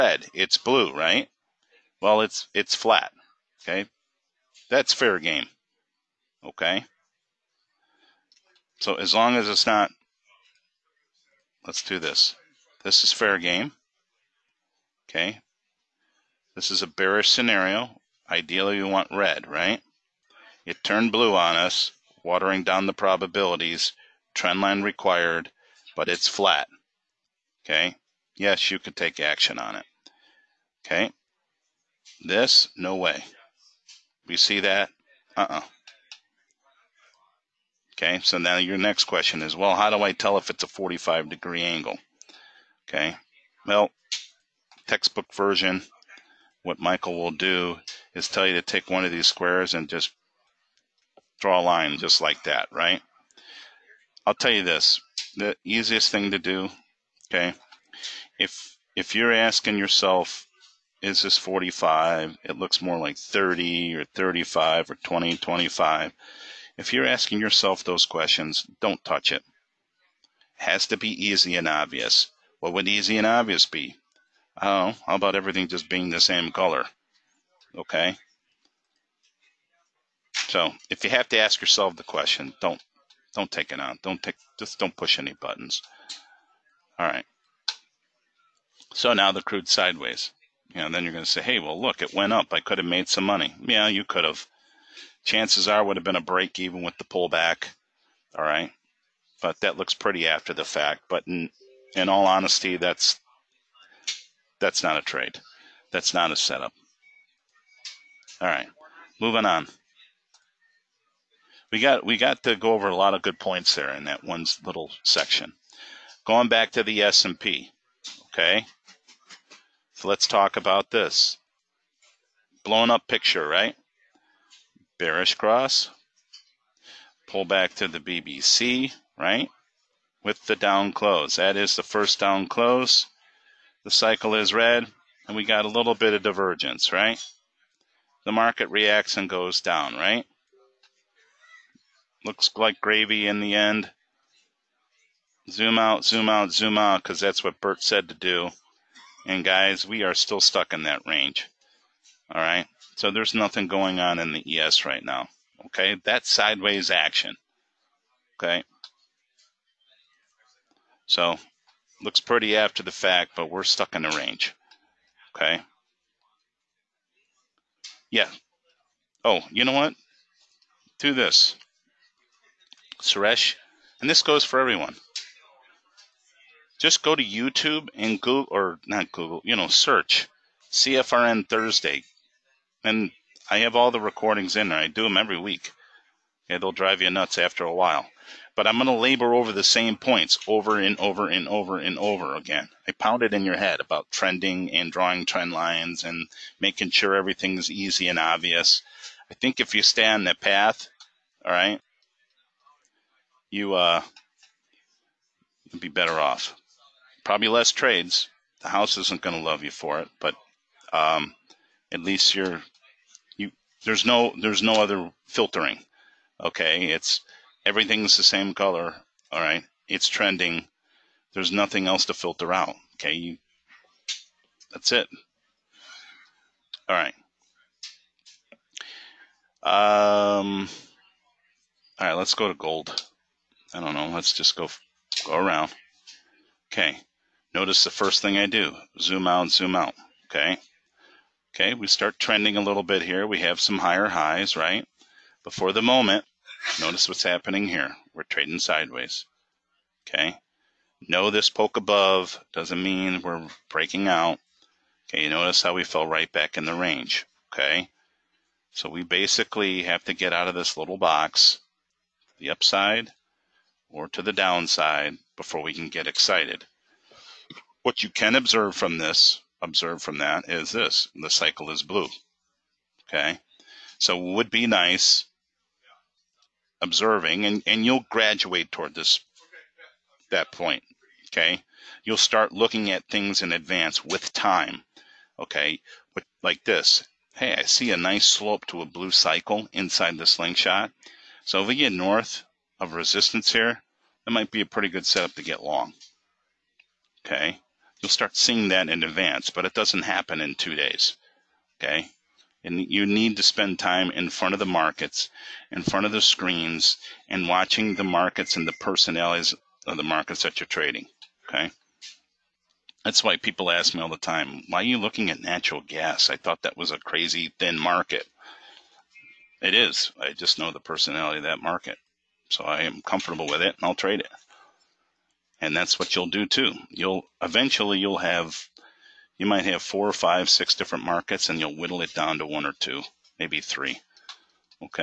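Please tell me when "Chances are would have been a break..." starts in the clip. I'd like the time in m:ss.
1:35.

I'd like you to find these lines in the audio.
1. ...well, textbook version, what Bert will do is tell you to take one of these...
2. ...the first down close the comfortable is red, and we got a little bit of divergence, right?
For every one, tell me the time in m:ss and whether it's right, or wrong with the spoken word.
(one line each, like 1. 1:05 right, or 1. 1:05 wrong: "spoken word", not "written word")
1. 0:43 wrong: "Michael", not "Bert"
2. 2:11 wrong: "cycle", not "comfortable".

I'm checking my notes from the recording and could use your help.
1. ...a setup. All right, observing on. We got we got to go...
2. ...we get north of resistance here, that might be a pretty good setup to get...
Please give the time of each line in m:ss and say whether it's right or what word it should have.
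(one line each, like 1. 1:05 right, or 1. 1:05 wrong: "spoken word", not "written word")
1. 1:46 wrong: "moving", not "observing"
2. 4:51 right.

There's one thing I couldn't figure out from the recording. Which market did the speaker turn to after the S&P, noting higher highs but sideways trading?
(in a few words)
Gold.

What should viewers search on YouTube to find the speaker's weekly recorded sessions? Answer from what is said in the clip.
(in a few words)
CFRN Thursday.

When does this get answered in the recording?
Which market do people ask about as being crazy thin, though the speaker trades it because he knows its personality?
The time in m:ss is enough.
5:15.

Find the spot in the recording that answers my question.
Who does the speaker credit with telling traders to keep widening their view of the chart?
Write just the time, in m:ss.
2:27.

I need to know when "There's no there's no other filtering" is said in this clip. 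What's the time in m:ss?
3:33.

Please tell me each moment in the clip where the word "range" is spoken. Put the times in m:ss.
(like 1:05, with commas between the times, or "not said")
2:31, 2:44, 4:16.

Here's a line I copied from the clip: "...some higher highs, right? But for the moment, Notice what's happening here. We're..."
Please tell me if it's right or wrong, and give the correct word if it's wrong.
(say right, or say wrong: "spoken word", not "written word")
right.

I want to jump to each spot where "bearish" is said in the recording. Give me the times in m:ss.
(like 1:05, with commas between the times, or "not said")
0:16, 2:04.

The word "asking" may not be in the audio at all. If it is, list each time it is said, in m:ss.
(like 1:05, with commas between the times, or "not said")
0:59, 1:07.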